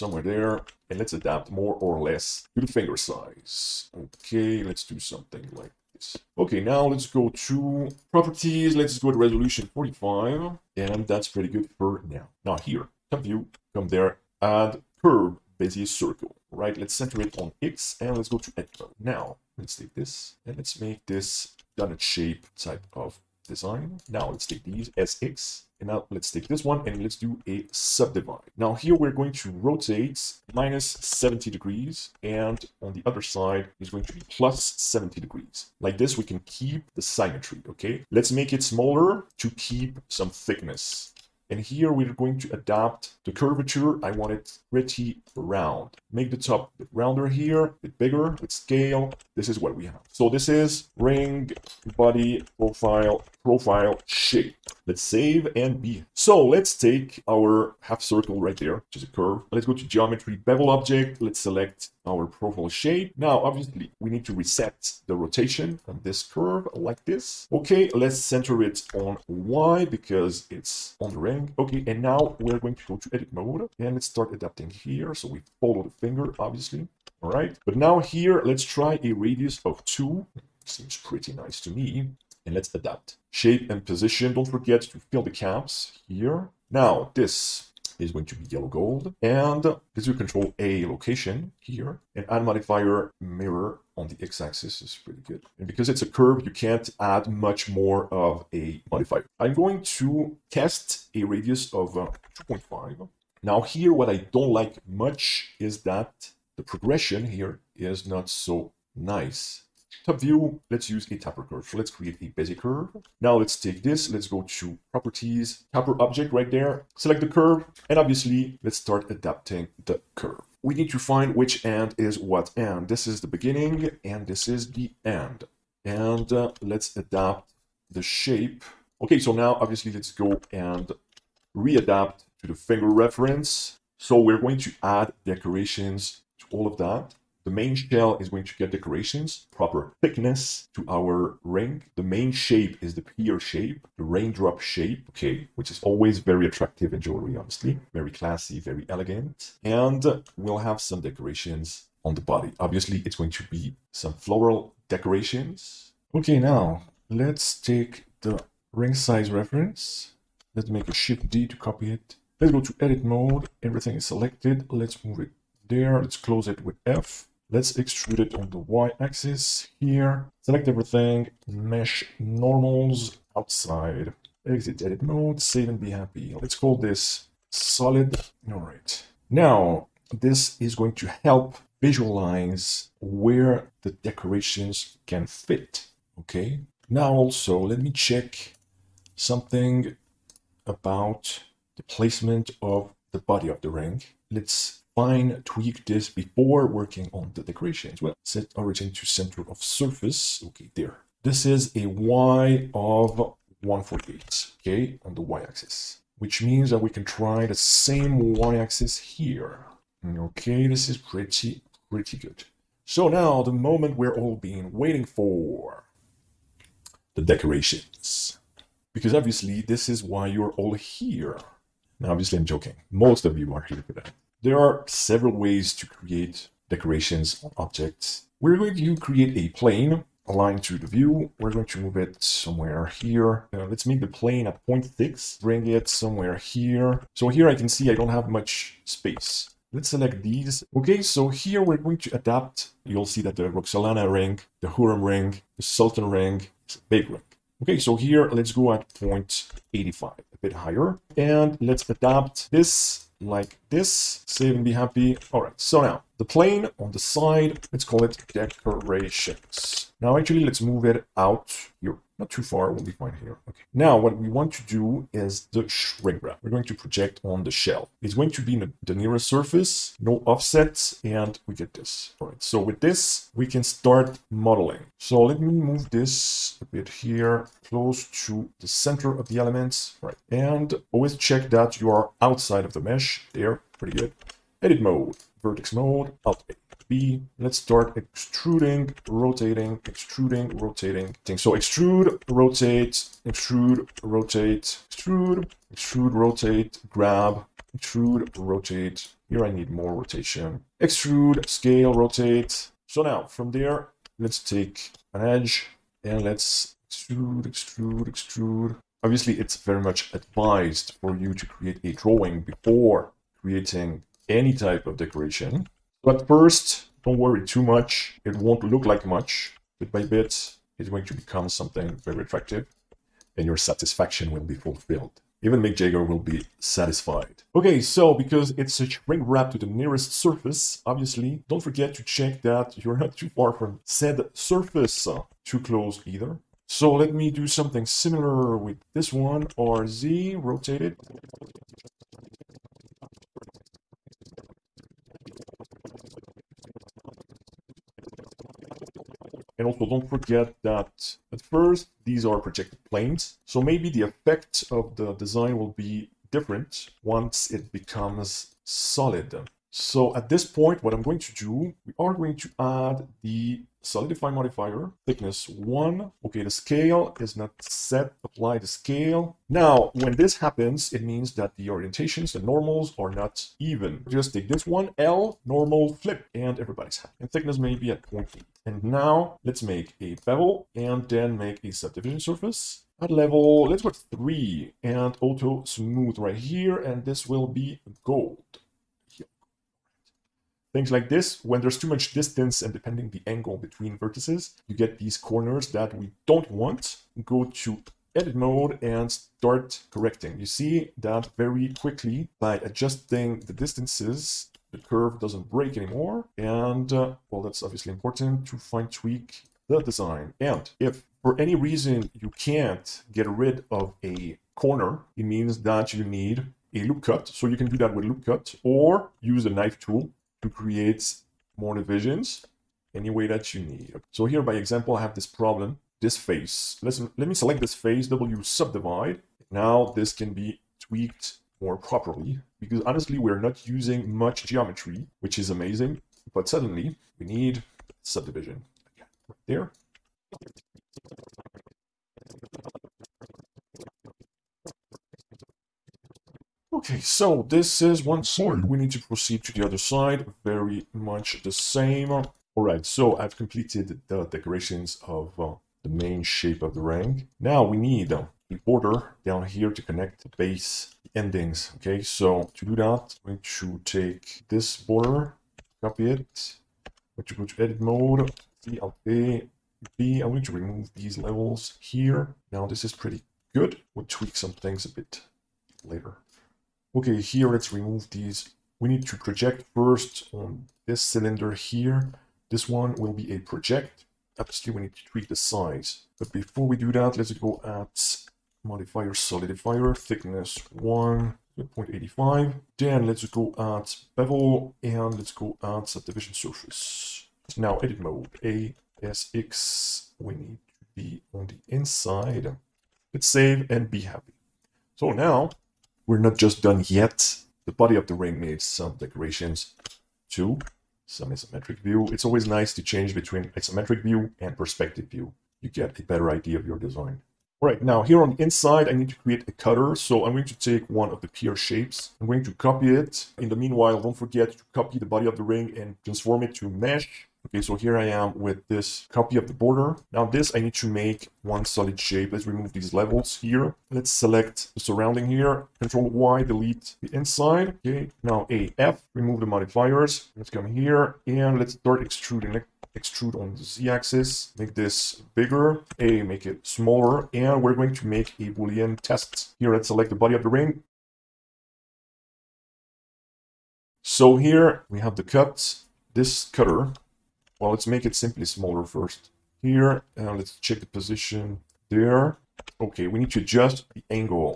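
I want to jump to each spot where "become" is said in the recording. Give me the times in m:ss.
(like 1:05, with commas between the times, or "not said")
5:21, 5:57.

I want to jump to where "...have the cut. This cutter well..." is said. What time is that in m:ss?
9:15.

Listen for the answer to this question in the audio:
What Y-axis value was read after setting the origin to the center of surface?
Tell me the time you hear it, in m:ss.
3:23.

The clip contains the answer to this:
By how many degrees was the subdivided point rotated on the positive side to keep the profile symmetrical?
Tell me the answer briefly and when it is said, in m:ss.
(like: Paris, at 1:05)
70, at 0:34.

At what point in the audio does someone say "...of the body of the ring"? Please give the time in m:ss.
3:12.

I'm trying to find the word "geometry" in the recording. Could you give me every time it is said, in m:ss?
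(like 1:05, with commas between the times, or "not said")
0:59, 7:14.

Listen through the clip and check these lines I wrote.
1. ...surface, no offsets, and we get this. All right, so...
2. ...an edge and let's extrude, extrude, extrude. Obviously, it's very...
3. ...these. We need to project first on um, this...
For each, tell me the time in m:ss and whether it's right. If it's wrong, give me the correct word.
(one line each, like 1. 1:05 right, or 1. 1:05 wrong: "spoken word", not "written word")
1. 4:29 right
2. 5:05 right
3. 7:58 right.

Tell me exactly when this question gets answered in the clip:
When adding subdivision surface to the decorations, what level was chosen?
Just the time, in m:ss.
6:23.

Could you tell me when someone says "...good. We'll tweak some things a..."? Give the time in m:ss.
7:53.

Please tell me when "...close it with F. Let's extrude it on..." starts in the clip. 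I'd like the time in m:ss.
2:46.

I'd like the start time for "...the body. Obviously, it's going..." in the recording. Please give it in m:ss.
2:32.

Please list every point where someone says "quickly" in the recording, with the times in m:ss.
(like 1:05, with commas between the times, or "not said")
6:41.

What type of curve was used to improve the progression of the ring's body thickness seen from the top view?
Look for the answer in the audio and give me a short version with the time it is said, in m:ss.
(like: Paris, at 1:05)
taper curve, at 1:51.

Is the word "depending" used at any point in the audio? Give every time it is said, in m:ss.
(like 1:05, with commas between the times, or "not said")
6:32.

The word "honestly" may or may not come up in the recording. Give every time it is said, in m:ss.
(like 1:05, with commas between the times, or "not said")
2:27, 7:12.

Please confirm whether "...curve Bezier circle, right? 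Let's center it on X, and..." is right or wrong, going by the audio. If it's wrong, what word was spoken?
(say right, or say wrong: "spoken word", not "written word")
right.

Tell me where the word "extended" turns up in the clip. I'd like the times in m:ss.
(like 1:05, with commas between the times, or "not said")
not said.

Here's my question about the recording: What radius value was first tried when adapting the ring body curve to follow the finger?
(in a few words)
2.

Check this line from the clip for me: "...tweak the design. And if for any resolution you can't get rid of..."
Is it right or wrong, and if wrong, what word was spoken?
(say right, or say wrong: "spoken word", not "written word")
wrong: "reason", not "resolution".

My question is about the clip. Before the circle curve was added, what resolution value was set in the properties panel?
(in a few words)
45.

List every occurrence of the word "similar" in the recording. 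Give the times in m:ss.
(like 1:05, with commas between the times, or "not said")
5:37.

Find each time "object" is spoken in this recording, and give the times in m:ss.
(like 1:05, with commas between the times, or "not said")
1:00, 1:56, 3:47.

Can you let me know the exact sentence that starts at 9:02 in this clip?
let extrude on the z-axis, make this bigger, A, make it smaller, and we're going to make a boolean test.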